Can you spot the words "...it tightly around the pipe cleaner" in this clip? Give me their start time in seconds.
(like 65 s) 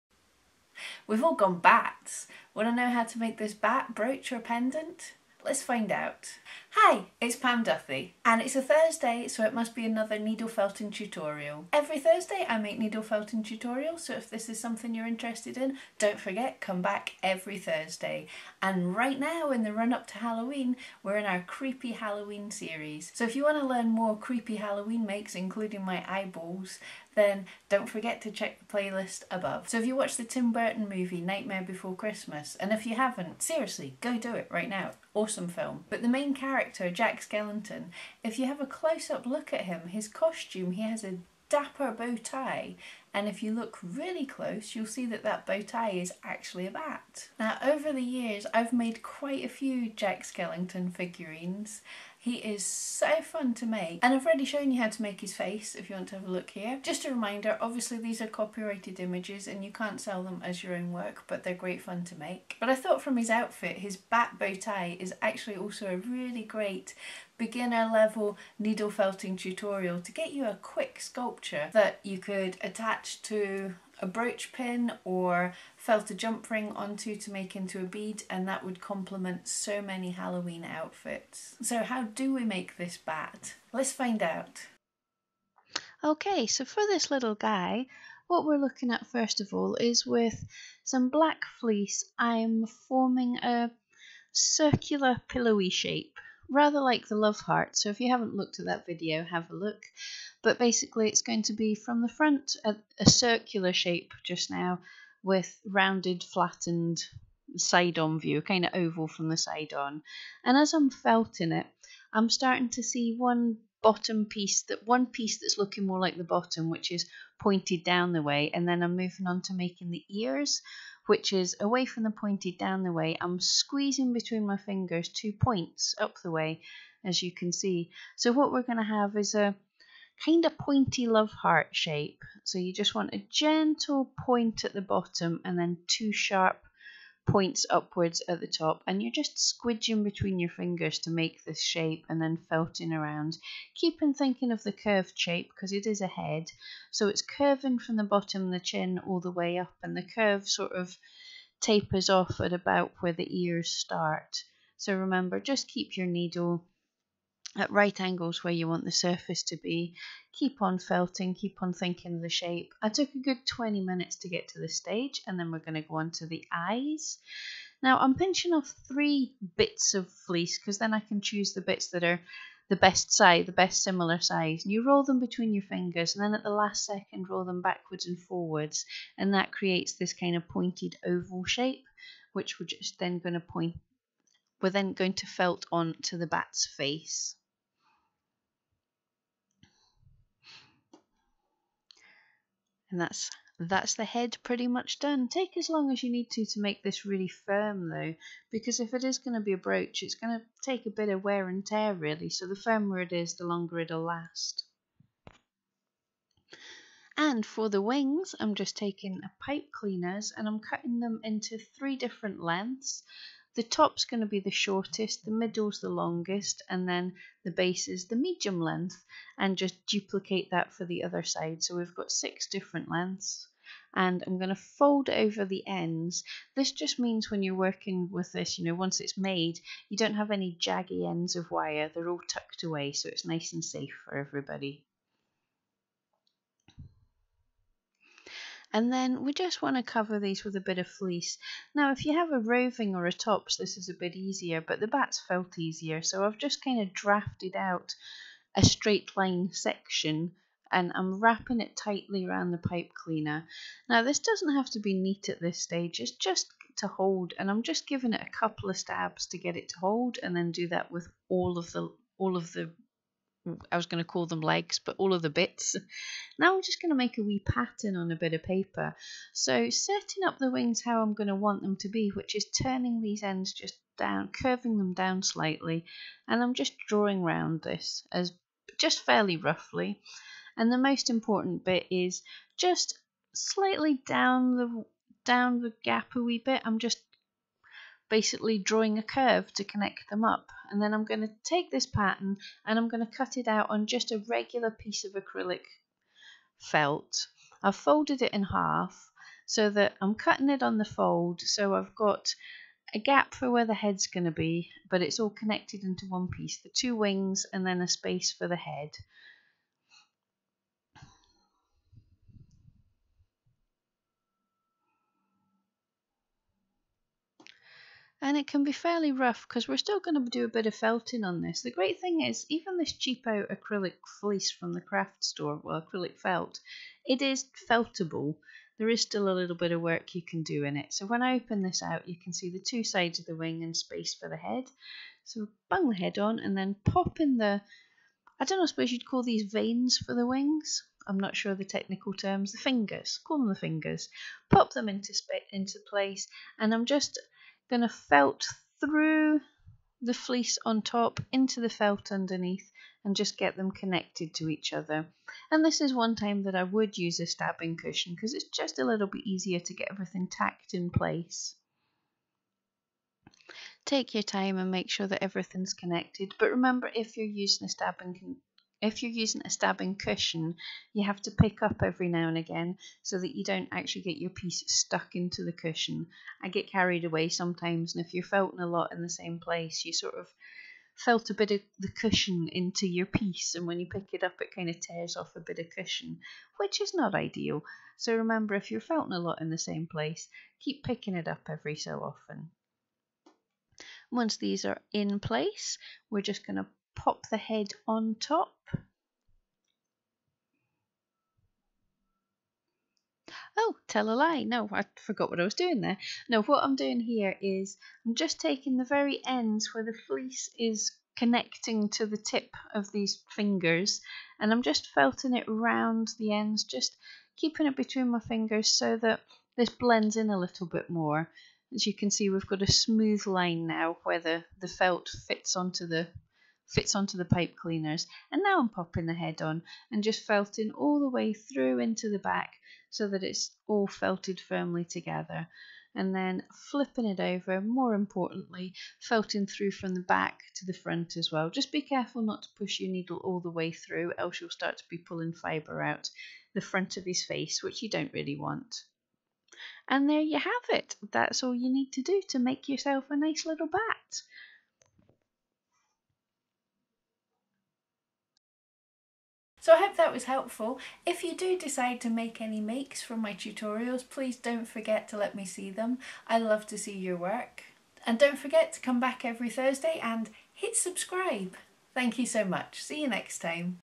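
251 s.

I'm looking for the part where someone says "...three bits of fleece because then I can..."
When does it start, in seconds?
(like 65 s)
168 s.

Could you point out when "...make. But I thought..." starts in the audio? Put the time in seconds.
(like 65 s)
62 s.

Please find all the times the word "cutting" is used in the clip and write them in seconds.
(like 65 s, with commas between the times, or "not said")
210 s, 300 s.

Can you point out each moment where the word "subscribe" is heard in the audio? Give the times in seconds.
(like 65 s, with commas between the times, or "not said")
470 s.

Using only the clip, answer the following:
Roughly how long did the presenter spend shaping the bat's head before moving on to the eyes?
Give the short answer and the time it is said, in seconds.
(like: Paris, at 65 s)
20 minutes, at 163 s.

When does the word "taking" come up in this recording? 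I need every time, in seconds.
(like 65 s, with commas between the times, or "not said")
208 s, 408 s.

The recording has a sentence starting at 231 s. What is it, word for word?
They're all tucked away, so it's nice and safe for everybody.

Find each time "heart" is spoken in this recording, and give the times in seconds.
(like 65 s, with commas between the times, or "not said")
97 s, 131 s.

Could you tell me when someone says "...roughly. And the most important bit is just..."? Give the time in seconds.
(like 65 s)
279 s.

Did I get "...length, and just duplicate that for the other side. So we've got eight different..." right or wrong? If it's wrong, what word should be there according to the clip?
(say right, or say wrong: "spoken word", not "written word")
wrong: "six", not "eight".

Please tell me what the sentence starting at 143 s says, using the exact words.
Keep thinking of the curved shape because it is a head.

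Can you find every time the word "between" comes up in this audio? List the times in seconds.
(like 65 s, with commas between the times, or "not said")
124 s, 140 s, 175 s, 417 s.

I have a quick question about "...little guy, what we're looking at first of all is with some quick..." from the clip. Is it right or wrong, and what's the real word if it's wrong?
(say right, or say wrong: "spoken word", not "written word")
wrong: "black", not "quick".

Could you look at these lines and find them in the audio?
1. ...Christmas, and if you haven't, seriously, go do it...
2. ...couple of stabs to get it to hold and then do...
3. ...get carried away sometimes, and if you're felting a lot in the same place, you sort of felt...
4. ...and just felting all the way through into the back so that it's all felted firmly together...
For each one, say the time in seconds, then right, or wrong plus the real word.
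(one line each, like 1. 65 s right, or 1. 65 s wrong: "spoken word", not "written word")
1. 31 s right
2. 258 s right
3. 376 s right
4. 429 s right.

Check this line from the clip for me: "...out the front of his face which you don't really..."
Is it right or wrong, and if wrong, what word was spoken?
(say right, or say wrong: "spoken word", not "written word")
right.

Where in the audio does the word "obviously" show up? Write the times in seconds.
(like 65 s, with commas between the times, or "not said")
57 s.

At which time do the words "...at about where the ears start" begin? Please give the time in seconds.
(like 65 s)
152 s.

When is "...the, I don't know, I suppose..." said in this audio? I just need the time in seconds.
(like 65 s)
337 s.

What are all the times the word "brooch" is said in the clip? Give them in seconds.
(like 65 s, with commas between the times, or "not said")
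3 s, 74 s, 199 s.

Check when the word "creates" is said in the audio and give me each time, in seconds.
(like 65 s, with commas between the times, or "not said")
179 s.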